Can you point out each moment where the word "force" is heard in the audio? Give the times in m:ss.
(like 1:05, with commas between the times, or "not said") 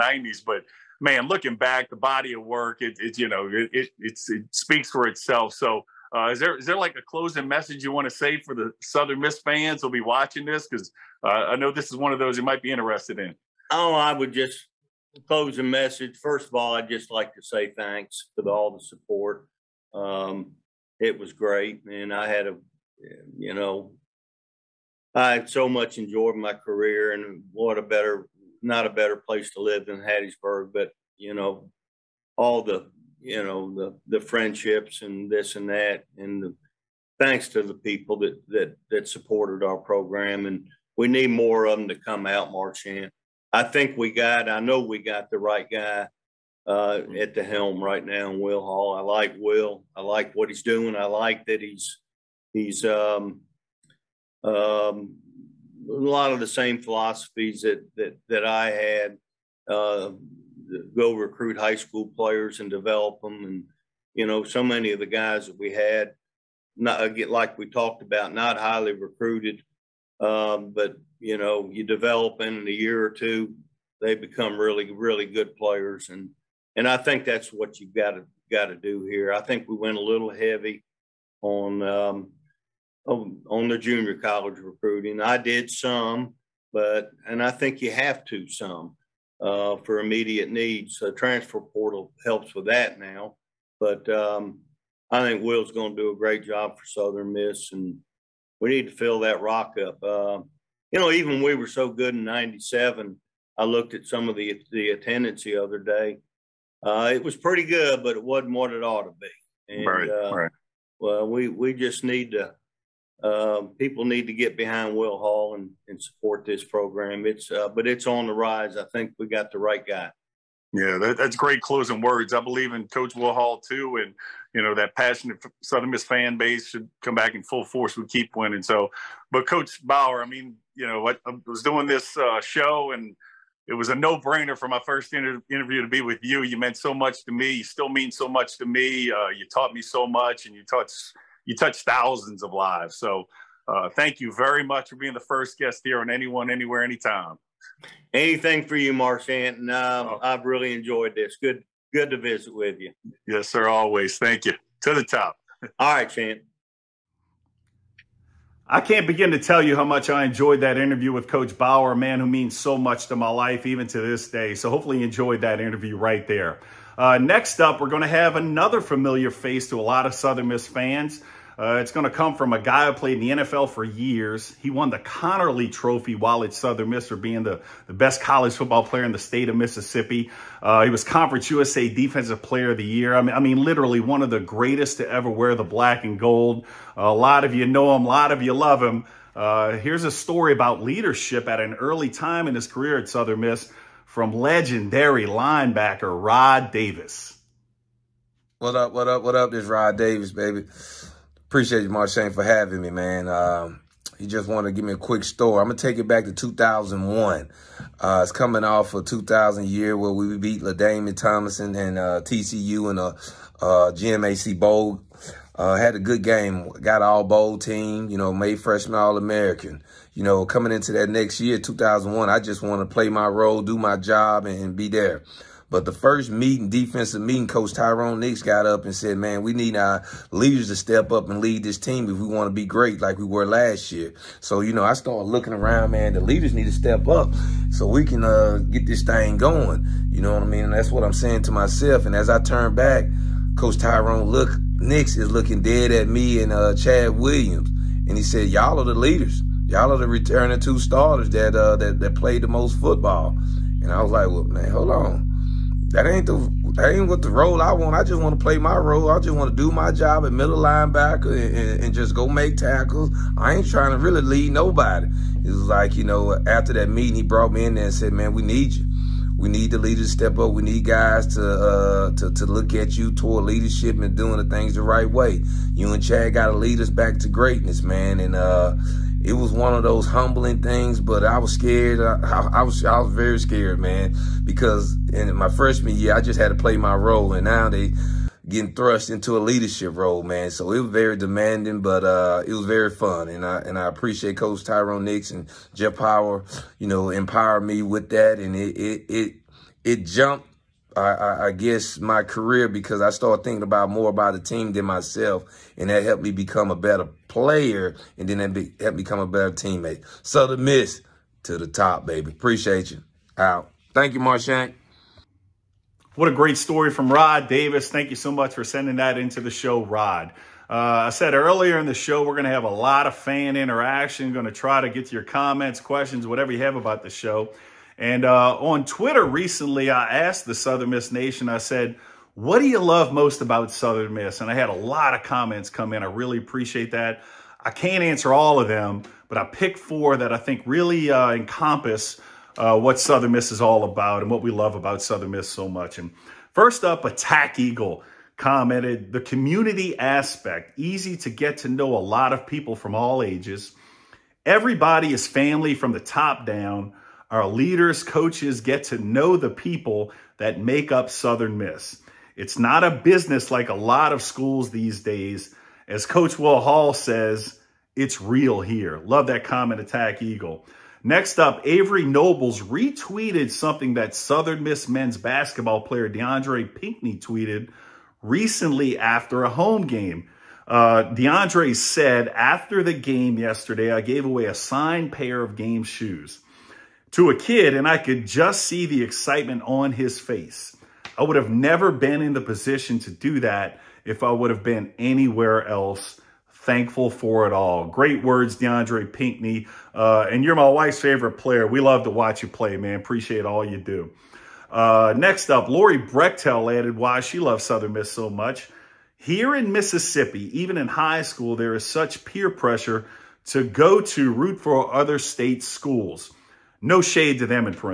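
2:07.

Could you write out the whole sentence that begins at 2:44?
So hopefully you enjoyed that interview right there.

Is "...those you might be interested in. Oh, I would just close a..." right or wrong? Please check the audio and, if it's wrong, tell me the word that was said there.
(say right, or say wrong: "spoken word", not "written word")
right.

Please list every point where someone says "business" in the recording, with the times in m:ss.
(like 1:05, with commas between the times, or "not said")
6:02.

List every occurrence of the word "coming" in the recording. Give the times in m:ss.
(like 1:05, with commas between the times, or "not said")
3:28, 3:40.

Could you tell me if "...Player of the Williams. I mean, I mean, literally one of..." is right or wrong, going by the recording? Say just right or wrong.
wrong.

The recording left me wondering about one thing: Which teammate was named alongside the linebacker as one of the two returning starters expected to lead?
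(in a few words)
Chad Williams.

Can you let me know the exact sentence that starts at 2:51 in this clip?
Uh, it's going to come from a guy who played in the NFL for years.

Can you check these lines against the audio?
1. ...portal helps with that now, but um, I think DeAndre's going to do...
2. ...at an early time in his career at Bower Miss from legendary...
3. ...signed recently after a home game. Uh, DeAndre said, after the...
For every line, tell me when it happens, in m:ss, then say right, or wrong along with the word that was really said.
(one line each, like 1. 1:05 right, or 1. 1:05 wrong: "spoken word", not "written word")
1. 1:31 wrong: "Will", not "DeAndre"
2. 3:11 wrong: "Southern", not "Bower"
3. 6:17 wrong: "tweeted", not "signed".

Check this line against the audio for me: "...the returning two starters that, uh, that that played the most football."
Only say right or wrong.
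right.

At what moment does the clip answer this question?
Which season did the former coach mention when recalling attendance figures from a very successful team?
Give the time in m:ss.
1:42.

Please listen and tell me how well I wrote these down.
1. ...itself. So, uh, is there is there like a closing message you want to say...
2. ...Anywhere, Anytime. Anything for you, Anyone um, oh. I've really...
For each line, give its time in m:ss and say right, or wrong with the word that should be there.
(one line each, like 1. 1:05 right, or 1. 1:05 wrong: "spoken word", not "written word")
1. 0:05 right
2. 2:26 wrong: "Marchant", not "Anyone".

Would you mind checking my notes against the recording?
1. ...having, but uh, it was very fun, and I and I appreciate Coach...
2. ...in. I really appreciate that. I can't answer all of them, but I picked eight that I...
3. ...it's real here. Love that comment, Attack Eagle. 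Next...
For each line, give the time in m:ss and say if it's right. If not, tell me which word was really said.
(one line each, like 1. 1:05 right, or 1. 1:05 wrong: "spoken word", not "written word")
1. 4:51 wrong: "demanding", not "having"
2. 5:35 wrong: "four", not "eight"
3. 6:07 right.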